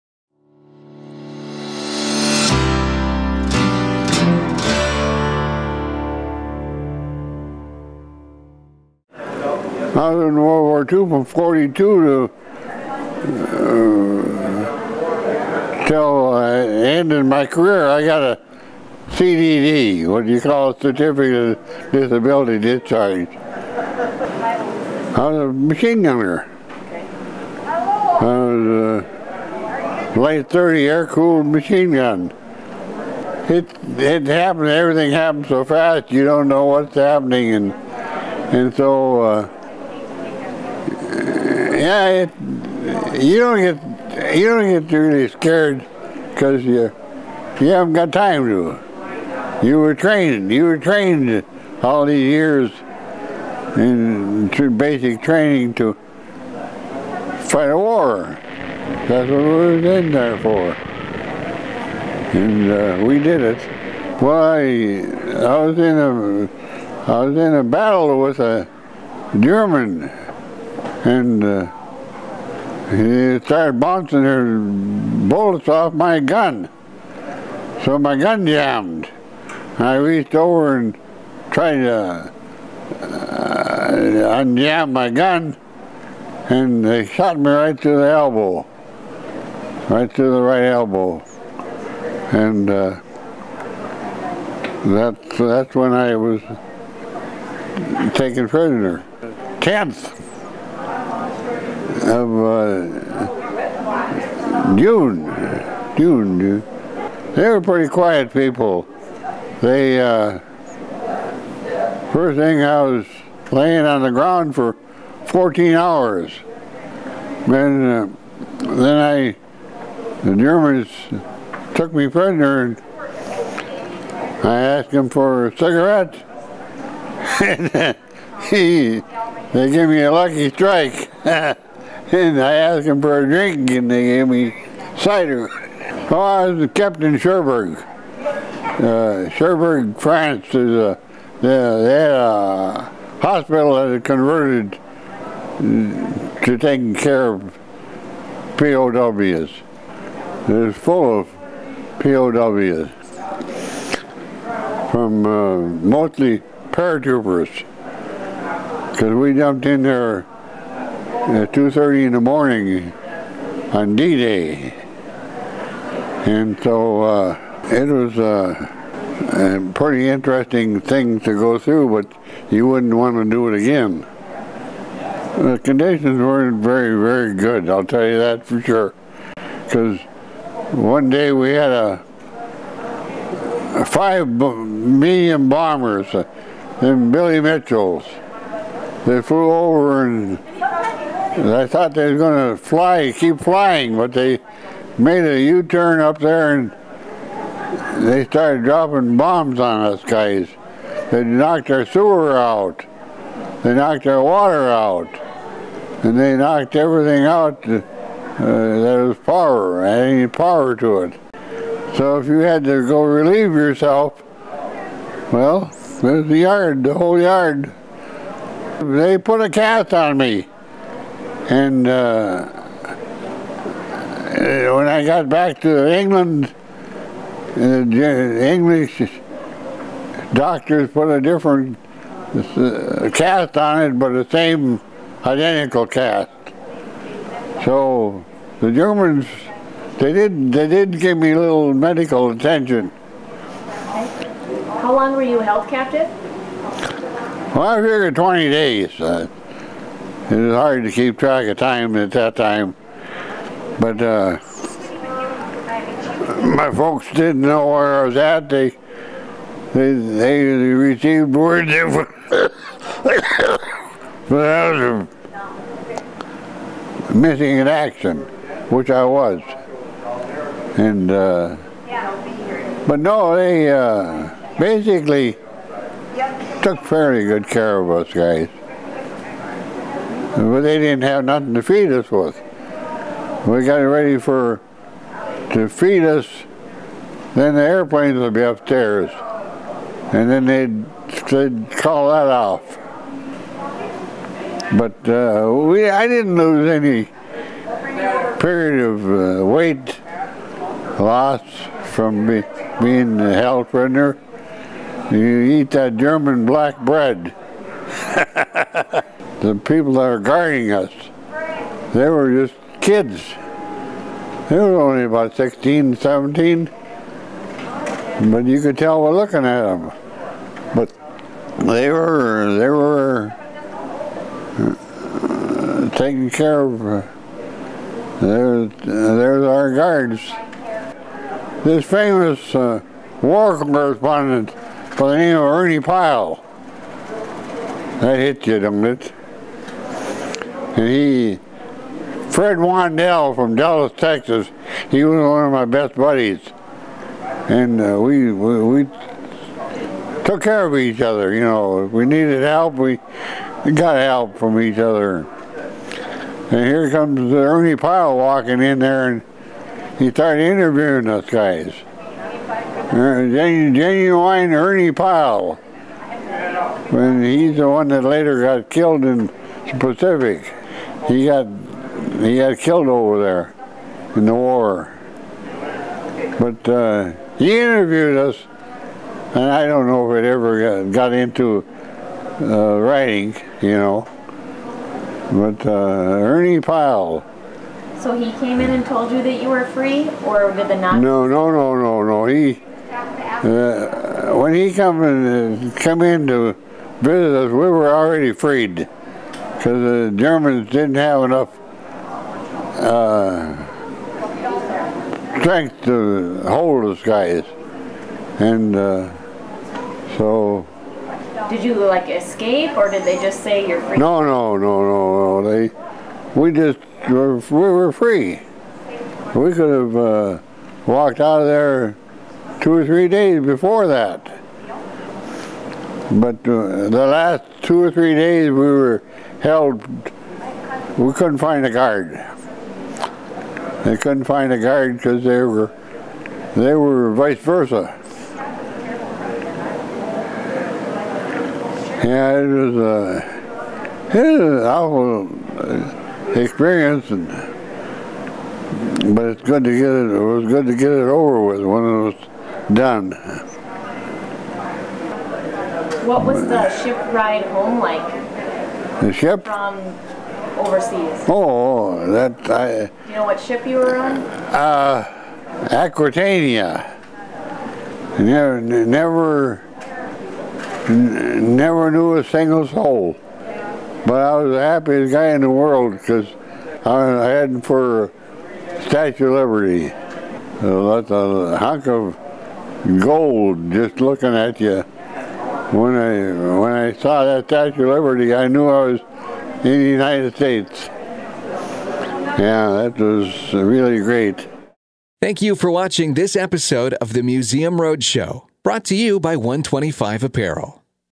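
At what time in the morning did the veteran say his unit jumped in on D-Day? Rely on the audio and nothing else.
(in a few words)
2:30.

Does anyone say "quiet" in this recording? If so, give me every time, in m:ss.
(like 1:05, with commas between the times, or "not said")
1:47.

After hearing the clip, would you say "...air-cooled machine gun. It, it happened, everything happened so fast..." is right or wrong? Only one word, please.
right.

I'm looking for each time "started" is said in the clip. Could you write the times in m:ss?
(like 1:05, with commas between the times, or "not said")
1:13, 3:18, 6:00.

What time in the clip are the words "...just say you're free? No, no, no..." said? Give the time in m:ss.
6:53.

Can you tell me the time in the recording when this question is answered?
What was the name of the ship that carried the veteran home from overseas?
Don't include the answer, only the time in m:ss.
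7:45.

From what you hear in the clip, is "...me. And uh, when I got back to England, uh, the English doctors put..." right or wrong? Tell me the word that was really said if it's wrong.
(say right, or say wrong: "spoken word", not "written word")
right.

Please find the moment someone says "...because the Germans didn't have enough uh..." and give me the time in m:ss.
6:39.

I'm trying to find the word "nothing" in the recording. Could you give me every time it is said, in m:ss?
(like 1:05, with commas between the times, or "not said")
4:41.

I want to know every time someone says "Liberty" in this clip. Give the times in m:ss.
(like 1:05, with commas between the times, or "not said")
7:59, 8:07.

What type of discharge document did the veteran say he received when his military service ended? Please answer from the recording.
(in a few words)
certificate of disability discharge.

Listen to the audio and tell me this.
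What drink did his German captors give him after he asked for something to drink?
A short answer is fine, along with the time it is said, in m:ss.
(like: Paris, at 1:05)
cider, at 2:14.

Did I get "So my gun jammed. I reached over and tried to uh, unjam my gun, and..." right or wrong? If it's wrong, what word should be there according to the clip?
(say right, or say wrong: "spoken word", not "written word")
right.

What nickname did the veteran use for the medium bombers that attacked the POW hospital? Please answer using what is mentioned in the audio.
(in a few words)
Billy Mitchell's.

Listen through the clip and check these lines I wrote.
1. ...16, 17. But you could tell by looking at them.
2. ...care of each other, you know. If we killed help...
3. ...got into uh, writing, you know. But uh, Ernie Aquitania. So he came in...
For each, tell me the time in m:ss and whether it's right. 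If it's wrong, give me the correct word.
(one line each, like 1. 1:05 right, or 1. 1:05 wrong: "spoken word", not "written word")
1. 5:15 right
2. 5:50 wrong: "needed", not "killed"
3. 6:20 wrong: "Pyle", not "Aquitania".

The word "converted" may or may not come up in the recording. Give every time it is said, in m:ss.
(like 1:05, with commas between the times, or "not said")
2:24.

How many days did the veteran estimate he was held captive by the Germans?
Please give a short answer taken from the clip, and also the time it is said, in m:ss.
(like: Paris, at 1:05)
20, at 4:08.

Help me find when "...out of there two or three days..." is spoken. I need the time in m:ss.
7:01.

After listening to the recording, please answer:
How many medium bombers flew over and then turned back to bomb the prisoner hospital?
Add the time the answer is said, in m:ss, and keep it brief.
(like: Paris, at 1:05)
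5, at 3:03.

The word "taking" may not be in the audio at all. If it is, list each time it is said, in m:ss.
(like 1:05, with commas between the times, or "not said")
2:26, 5:25.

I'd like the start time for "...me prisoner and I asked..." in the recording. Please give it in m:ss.
2:01.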